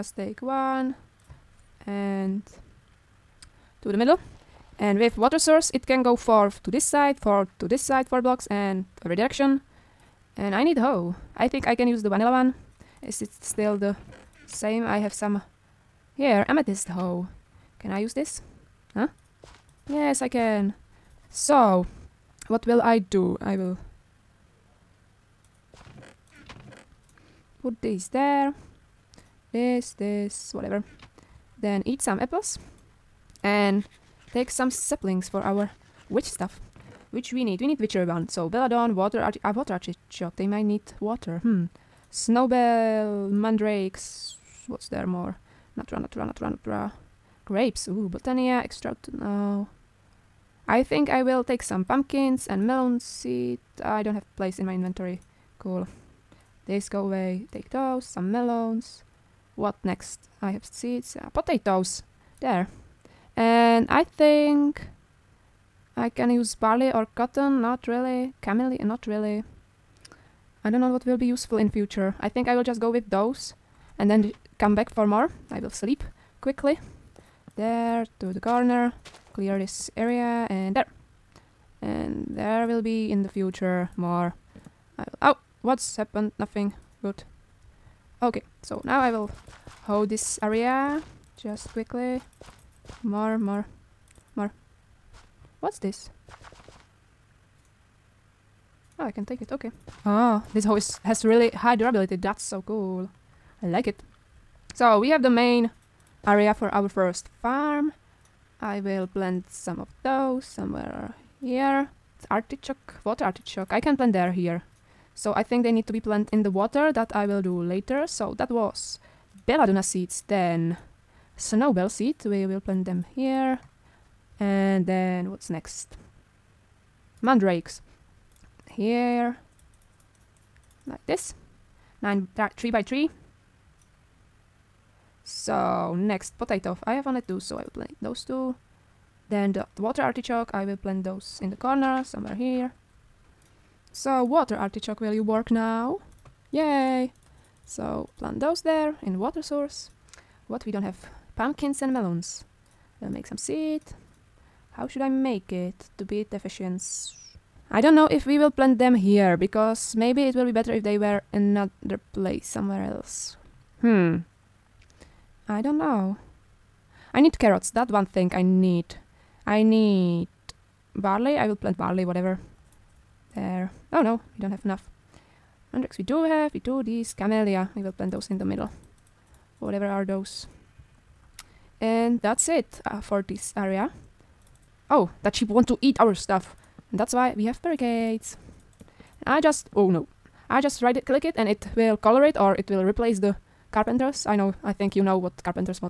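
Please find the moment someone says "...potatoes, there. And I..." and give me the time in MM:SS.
01:01.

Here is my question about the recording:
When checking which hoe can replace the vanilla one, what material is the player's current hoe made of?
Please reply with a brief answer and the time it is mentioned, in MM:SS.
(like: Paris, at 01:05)
Amethyst, at 00:16.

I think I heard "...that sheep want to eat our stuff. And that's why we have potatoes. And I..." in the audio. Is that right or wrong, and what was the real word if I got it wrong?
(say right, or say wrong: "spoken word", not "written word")
wrong: "barricades", not "potatoes".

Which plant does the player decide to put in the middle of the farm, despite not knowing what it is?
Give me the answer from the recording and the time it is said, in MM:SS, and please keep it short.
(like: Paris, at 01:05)
Camellia, at 02:57.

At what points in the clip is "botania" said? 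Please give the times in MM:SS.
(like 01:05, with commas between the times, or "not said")
00:48.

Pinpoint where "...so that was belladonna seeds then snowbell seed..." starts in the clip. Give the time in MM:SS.
01:58.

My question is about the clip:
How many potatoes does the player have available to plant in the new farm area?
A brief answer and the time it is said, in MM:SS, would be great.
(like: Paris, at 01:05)
2, at 02:16.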